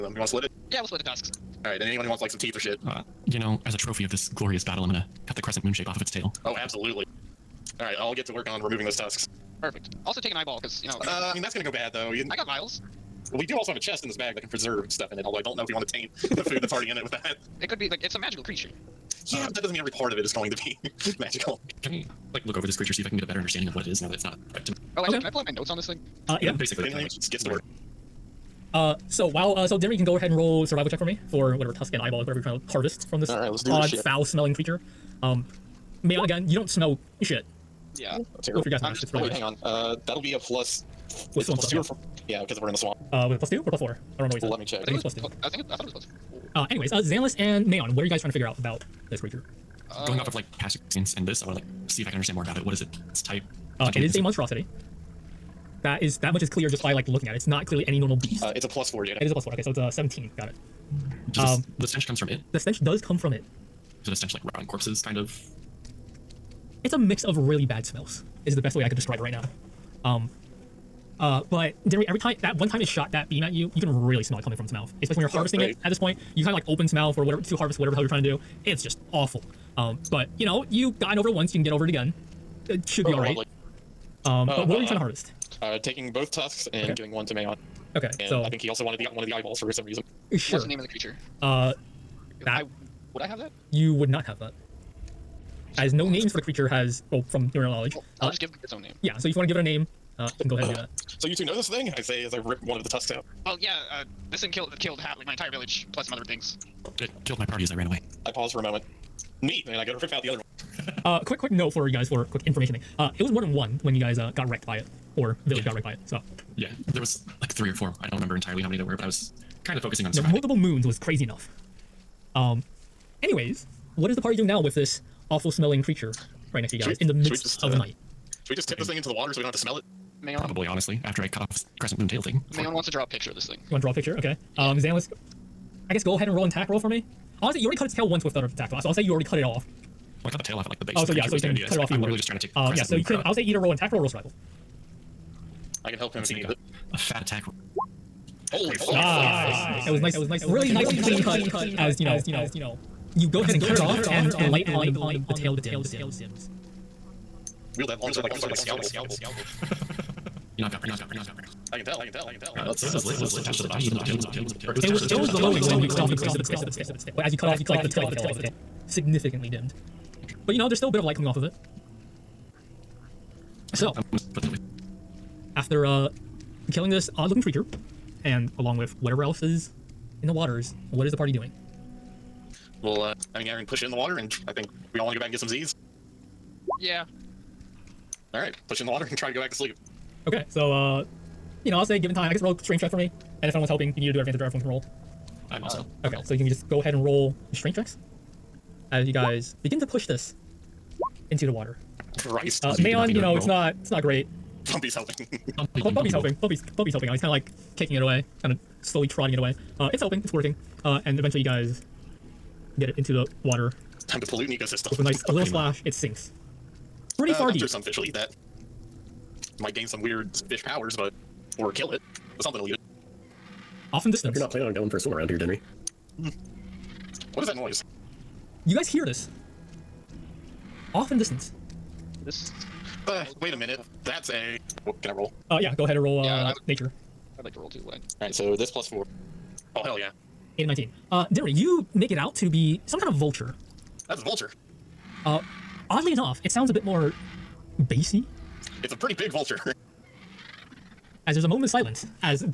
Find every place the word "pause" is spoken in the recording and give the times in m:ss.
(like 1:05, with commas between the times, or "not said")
1:48.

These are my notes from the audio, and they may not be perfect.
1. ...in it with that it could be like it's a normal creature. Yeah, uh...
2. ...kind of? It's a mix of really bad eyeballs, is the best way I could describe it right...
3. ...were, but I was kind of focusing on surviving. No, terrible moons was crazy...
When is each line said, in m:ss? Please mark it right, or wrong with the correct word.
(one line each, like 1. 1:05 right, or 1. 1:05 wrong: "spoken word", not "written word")
1. 0:16 wrong: "magical", not "normal"
2. 1:05 wrong: "smells", not "eyeballs"
3. 1:58 wrong: "multiple", not "terrible".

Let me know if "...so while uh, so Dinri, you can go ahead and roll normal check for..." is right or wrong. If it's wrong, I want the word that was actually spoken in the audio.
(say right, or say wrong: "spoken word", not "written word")
wrong: "survival", not "normal".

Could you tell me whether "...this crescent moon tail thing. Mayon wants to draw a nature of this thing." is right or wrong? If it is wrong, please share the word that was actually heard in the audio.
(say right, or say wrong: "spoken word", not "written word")
wrong: "picture", not "nature".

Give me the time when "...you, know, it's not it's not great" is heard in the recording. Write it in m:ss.
3:23.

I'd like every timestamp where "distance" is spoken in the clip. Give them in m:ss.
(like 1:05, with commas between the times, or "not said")
3:44, 3:51.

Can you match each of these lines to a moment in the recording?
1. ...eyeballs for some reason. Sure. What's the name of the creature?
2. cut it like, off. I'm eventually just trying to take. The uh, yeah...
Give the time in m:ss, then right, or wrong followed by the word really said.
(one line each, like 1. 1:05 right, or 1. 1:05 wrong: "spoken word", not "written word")
1. 1:29 right
2. 2:21 wrong: "literally", not "eventually".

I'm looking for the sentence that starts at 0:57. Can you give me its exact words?
It's not clearly any normal beast.